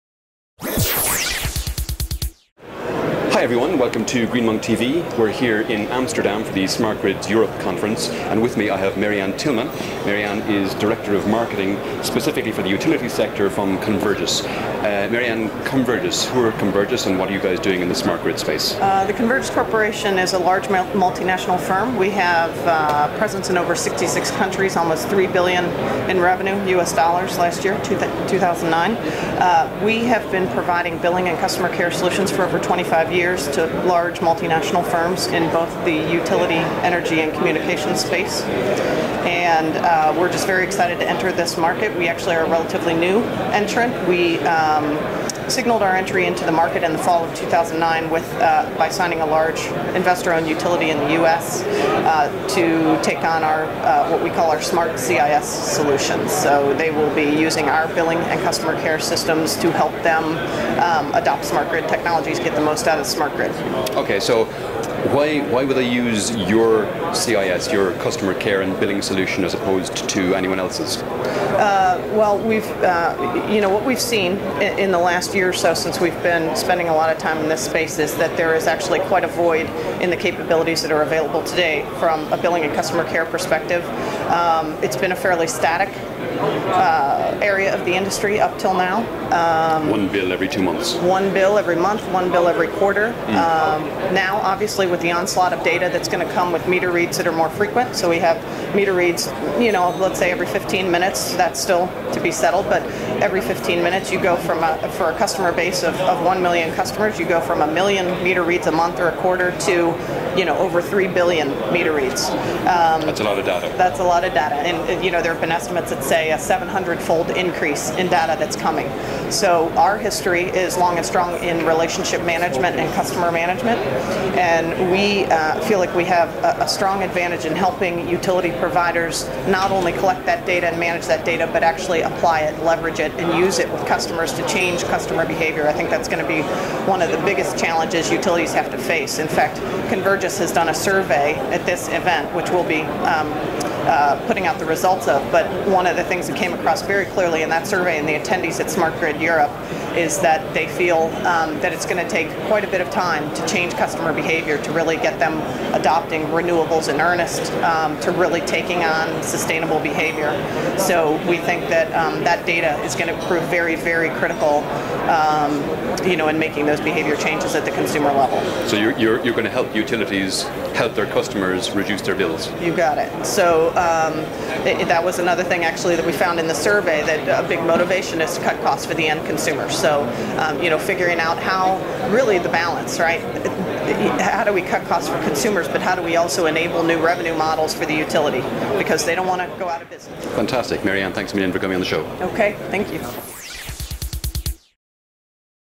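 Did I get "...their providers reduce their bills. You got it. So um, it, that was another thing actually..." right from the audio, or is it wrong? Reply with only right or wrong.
wrong.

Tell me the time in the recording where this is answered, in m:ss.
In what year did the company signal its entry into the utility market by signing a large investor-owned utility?
0:46.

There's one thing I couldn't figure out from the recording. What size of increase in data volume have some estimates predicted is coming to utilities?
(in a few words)
700-fold.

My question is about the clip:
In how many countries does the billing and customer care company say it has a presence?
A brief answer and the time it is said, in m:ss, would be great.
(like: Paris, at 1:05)
66, at 0:23.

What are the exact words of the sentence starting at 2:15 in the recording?
I think that's going to be one of the biggest challenges utilities have to face.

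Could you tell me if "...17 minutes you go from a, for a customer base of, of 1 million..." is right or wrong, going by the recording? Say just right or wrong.
wrong.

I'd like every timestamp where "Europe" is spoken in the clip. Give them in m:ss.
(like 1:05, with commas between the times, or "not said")
0:07, 2:29.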